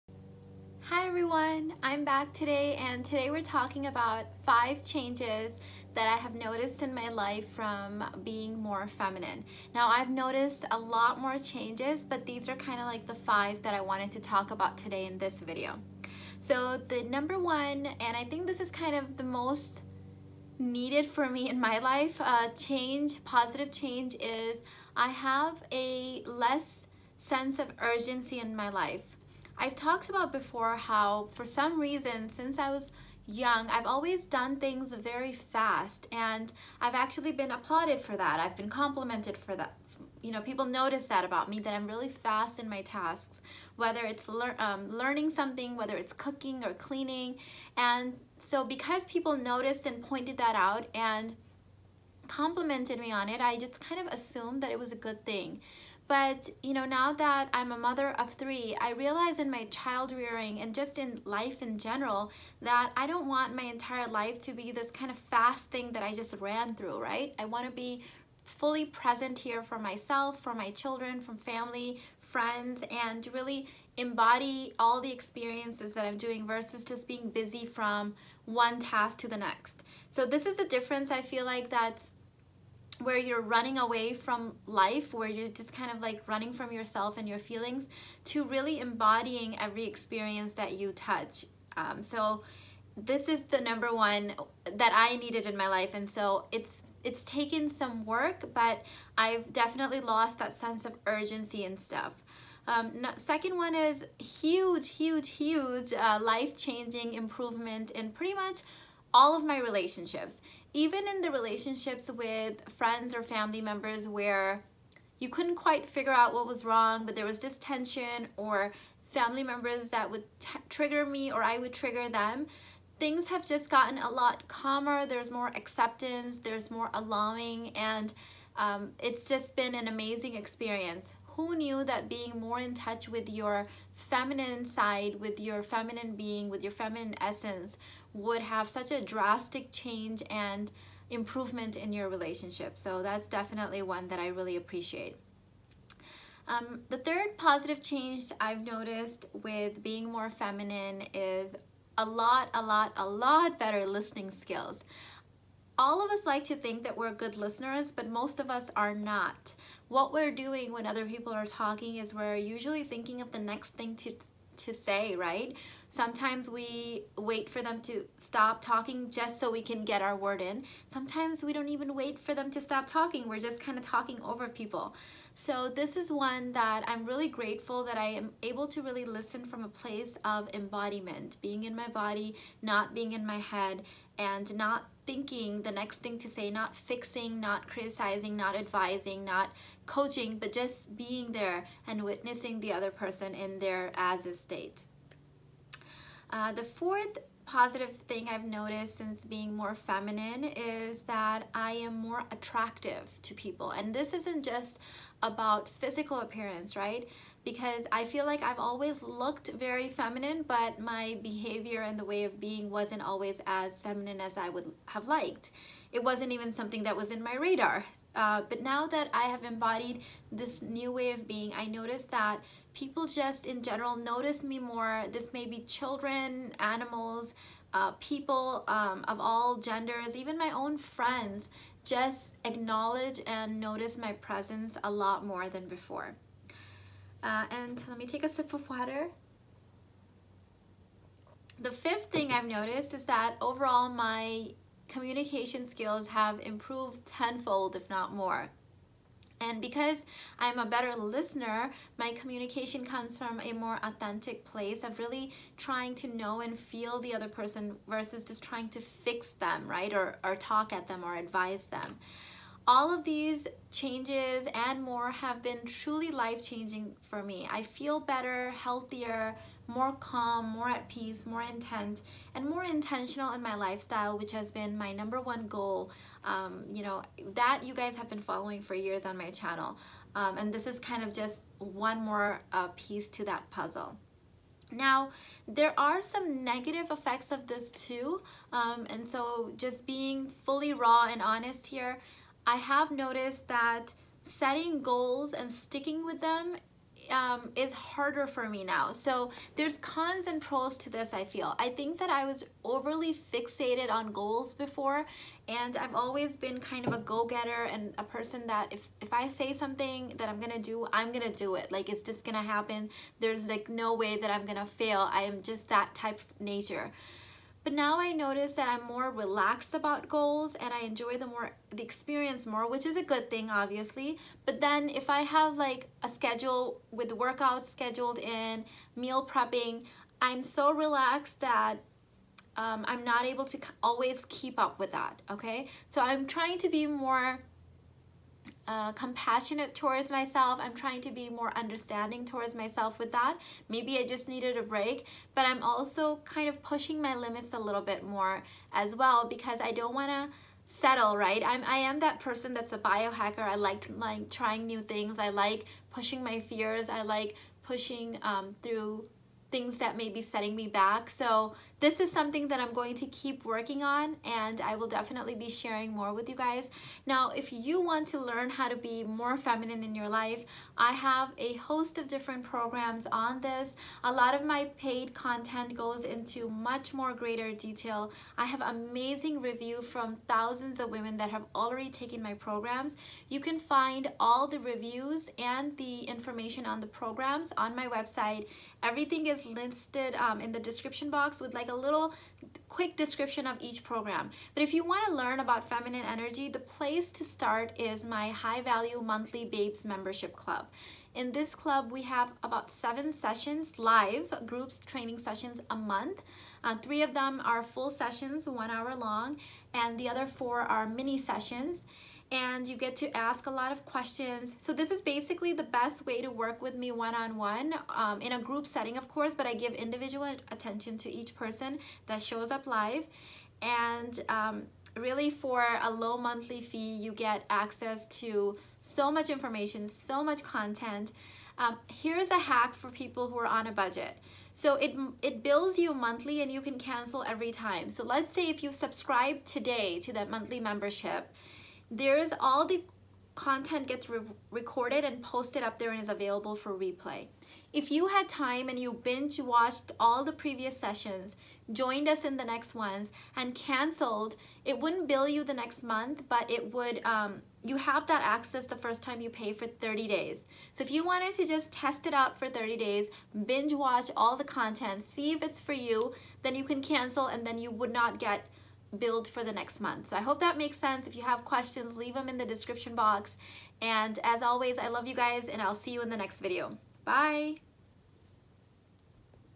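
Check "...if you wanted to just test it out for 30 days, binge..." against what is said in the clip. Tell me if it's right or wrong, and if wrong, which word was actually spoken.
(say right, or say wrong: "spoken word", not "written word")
right.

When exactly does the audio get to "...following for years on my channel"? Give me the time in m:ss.
4:38.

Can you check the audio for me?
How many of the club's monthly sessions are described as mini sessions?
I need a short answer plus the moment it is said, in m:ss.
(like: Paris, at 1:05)
4, at 6:50.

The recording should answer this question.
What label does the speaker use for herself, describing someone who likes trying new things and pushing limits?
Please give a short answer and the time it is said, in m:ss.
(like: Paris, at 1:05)
biohacker, at 5:52.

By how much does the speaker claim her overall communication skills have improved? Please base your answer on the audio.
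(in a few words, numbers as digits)
tenfold.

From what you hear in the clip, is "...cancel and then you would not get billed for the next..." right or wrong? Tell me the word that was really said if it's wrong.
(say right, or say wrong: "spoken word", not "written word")
right.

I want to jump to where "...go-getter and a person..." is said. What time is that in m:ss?
5:06.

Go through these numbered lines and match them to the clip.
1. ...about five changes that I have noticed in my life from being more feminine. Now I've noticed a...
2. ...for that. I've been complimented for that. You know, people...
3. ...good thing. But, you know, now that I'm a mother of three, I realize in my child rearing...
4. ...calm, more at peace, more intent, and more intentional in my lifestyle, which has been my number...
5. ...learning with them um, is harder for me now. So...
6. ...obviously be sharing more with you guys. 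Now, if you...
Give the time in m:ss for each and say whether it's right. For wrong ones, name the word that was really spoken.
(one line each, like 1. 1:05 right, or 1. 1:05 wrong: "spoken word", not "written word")
1. 0:03 right
2. 0:38 right
3. 0:54 right
4. 4:29 right
5. 4:55 wrong: "sticking", not "learning"
6. 6:04 wrong: "definitely", not "obviously".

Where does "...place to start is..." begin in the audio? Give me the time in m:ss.
6:36.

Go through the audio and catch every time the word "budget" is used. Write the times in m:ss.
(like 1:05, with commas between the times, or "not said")
7:13.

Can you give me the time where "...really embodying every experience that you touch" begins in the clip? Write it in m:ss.
1:28.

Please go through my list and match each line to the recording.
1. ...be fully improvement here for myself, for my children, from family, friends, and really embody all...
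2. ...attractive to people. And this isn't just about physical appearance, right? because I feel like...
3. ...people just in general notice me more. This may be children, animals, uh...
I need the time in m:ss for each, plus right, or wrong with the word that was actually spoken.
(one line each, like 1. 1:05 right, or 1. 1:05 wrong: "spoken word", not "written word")
1. 1:07 wrong: "present", not "improvement"
2. 3:22 right
3. 3:42 right.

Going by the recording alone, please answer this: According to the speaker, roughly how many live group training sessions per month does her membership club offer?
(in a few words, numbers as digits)
7.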